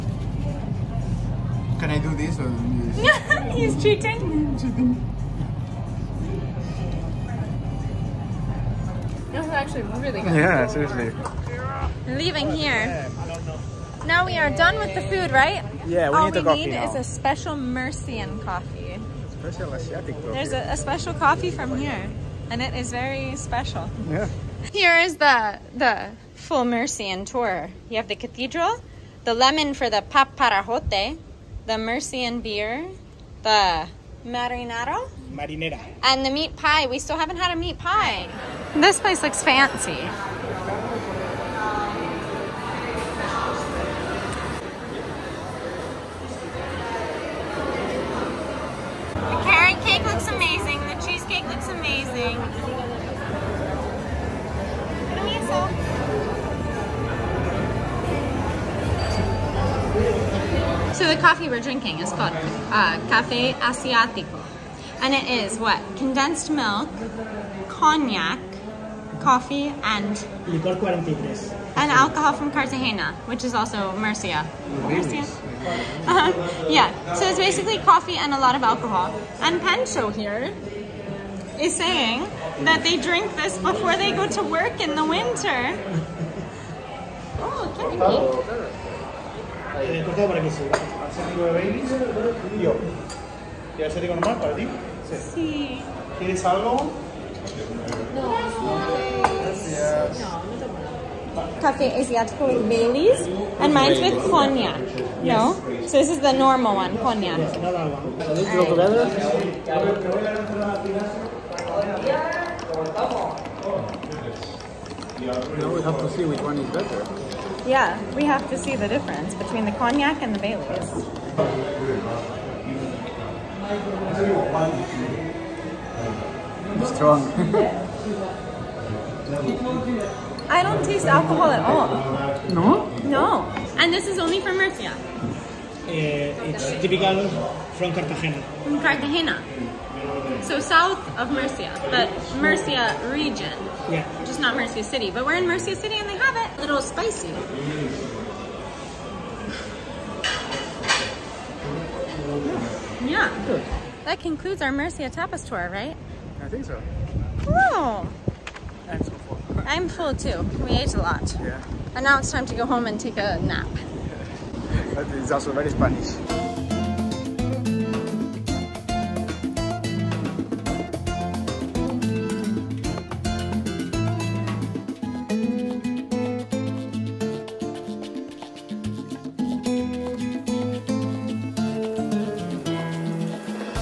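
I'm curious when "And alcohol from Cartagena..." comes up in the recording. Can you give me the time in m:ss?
1:11.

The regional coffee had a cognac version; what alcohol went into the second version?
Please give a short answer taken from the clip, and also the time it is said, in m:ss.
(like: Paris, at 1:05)
Bailey's, at 1:42.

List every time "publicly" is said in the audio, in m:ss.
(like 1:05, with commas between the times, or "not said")
not said.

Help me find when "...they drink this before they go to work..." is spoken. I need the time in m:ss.
1:22.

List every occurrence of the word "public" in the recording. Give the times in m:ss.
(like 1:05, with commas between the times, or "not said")
not said.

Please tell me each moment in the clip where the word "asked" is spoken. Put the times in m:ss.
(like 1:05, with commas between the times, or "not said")
not said.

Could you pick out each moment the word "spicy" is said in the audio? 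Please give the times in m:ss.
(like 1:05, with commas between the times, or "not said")
2:26.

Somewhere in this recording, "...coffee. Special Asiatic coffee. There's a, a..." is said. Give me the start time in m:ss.
0:18.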